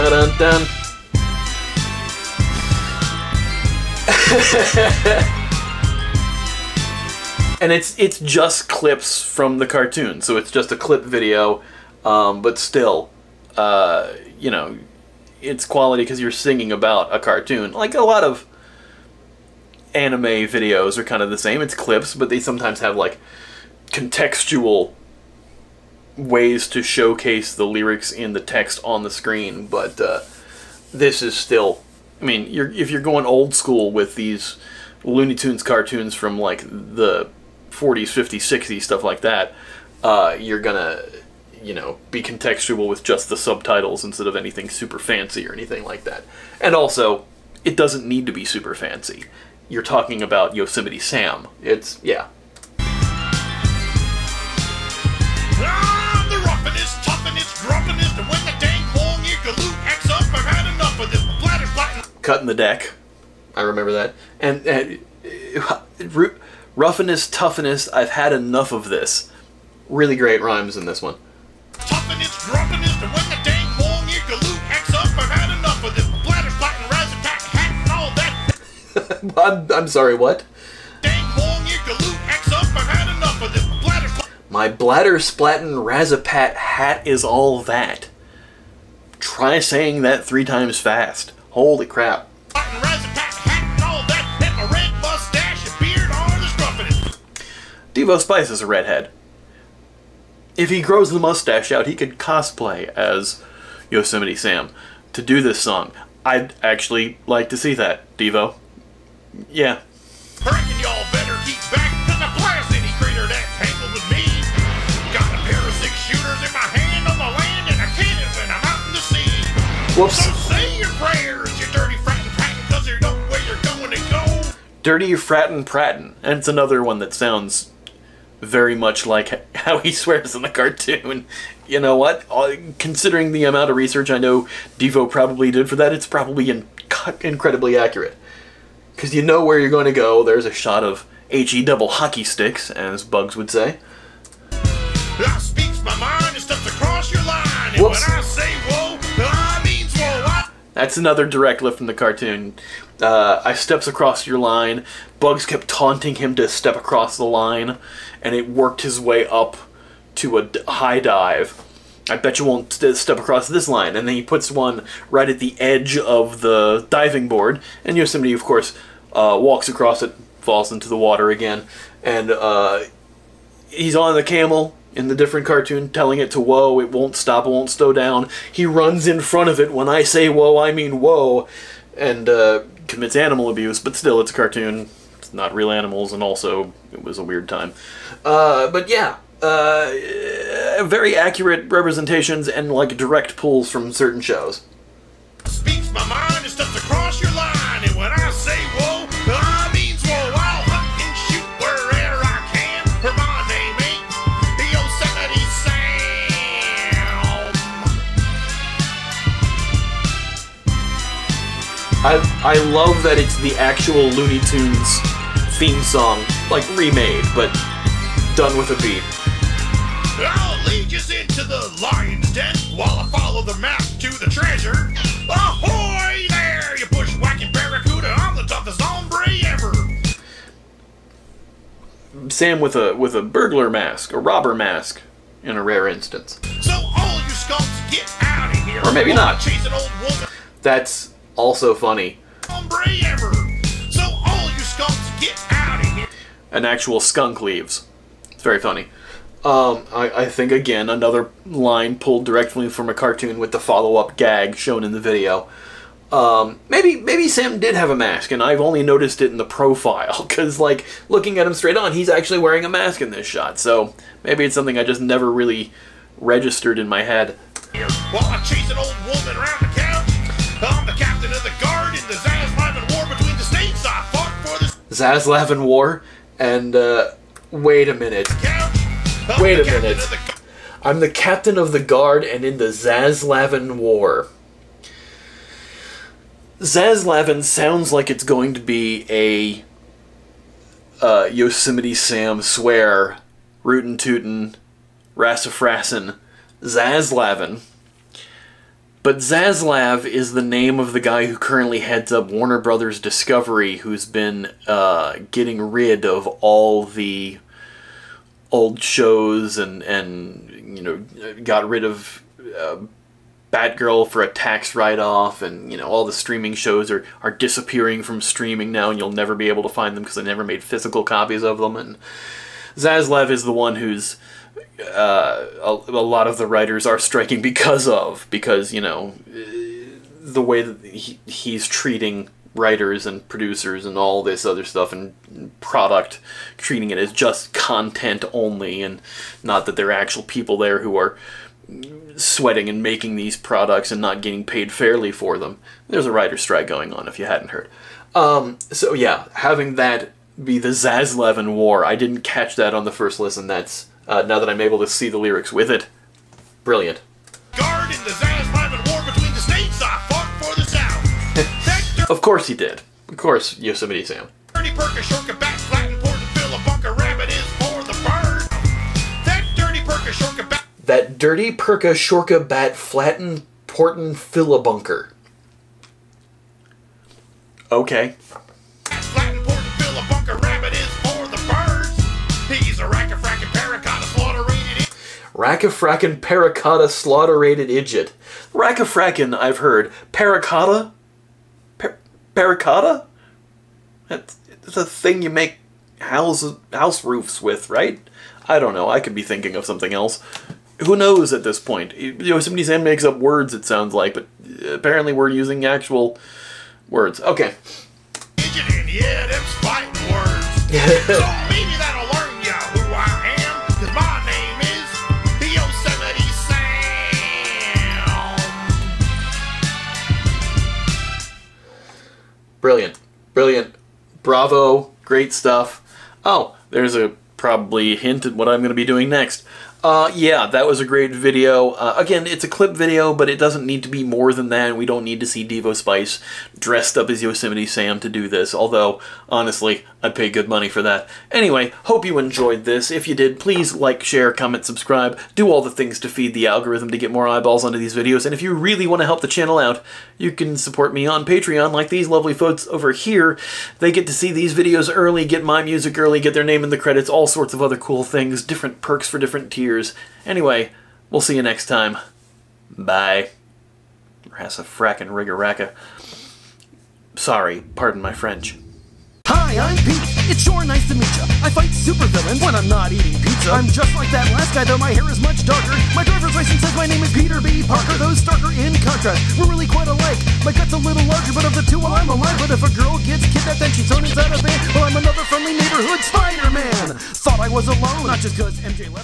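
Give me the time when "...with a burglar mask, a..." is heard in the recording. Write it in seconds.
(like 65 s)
232 s.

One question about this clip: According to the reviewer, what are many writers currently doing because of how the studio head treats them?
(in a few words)
striking.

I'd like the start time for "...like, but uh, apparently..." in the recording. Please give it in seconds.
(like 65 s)
403 s.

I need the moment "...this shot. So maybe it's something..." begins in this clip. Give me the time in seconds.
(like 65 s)
263 s.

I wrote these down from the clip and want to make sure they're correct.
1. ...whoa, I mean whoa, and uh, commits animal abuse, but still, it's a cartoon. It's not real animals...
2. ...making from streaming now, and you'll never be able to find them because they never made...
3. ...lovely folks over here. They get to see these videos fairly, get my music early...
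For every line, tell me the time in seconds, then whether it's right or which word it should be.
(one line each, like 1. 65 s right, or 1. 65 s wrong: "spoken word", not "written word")
1. 180 s right
2. 317 s wrong: "disappearing", not "making"
3. 452 s wrong: "early", not "fairly".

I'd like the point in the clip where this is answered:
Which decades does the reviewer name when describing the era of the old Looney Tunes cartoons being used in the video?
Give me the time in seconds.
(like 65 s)
37 s.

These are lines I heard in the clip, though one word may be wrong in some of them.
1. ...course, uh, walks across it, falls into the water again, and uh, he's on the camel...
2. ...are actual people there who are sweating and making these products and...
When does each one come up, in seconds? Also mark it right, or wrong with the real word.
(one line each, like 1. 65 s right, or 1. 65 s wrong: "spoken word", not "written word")
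1. 168 s right
2. 339 s right.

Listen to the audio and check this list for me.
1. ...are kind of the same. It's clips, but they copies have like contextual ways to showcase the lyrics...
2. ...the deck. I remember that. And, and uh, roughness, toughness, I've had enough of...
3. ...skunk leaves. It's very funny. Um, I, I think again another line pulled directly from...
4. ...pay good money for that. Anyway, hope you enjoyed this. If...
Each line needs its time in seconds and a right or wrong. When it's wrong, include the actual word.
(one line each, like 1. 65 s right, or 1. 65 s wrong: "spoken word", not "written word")
1. 20 s wrong: "sometimes", not "copies"
2. 62 s right
3. 246 s right
4. 440 s right.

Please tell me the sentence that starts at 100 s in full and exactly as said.
if he grows the mustache out, he could cosplay as Yosemite Sam to do this song.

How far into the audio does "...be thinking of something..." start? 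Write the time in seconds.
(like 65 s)
399 s.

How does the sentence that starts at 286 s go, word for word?
Zaslavin sounds like it's going to be a uh, Yosemite Sam swear, rootin' tootin', rassifrasin', Zaslavin.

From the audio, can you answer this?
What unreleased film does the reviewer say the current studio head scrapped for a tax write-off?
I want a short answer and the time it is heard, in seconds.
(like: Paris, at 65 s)
Batgirl, at 313 s.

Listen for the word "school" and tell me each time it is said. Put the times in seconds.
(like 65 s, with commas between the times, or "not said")
33 s.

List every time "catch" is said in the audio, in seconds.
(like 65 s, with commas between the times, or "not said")
352 s.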